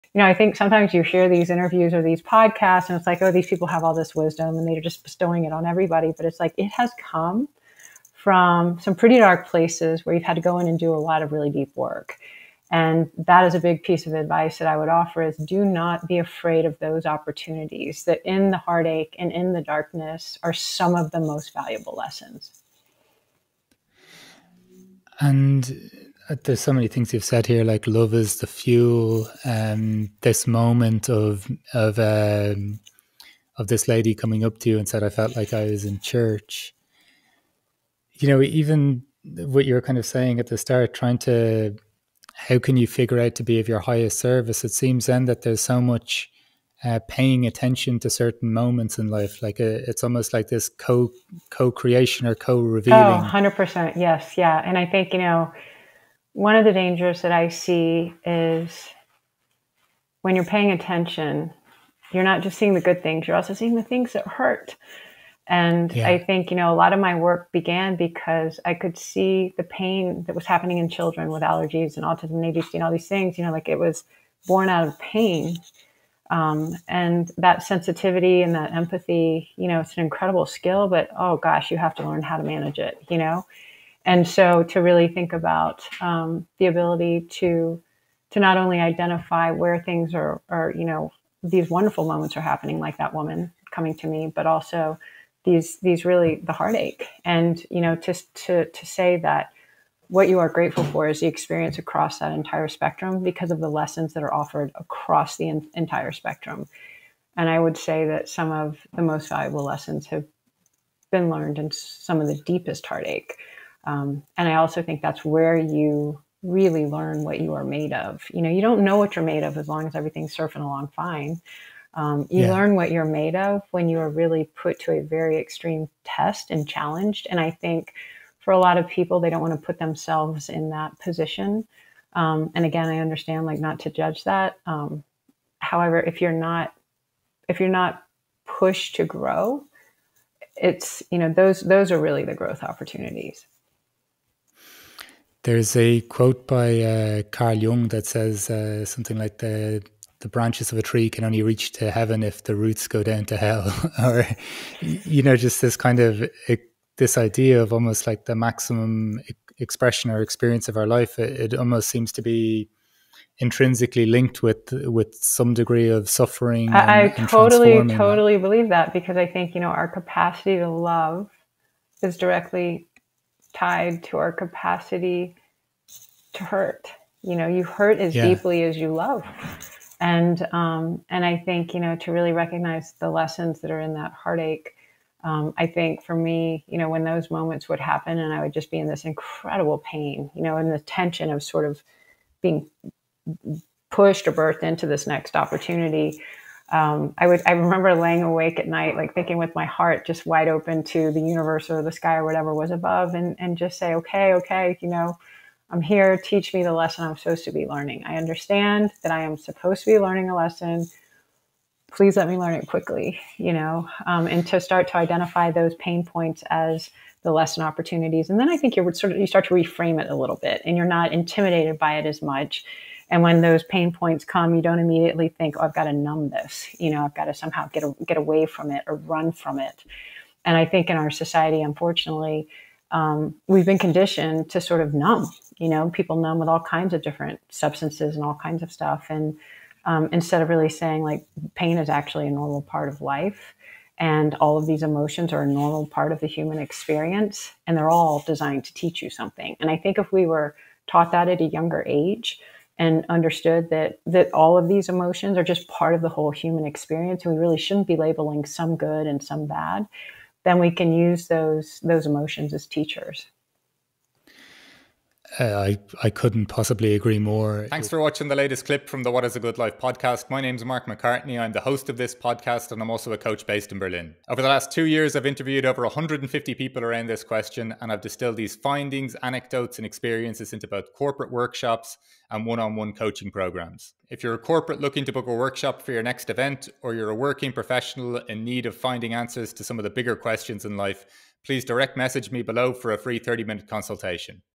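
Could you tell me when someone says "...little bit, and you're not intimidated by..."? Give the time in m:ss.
3:40.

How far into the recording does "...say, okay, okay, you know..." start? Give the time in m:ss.
3:23.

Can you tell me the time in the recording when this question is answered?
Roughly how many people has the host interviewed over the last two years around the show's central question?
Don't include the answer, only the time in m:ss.
4:35.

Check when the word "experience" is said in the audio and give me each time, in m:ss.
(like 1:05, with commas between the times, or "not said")
1:41, 2:40, 4:06, 4:16, 4:39.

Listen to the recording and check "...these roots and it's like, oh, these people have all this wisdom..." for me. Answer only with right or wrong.
wrong.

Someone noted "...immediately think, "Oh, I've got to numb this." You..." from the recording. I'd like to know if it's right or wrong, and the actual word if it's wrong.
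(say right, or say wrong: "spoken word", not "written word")
right.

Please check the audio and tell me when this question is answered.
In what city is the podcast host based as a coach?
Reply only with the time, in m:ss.
4:33.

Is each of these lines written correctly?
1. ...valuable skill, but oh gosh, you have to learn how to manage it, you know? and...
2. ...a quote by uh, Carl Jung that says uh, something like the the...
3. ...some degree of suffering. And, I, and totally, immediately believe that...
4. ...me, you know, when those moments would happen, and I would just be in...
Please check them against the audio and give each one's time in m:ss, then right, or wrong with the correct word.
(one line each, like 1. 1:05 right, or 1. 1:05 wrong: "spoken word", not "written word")
1. 1:20 wrong: "incredible", not "valuable"
2. 2:25 right
3. 2:45 wrong: "totally", not "immediately"
4. 3:06 right.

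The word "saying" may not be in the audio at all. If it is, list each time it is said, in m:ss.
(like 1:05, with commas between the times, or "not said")
0:40, 4:00.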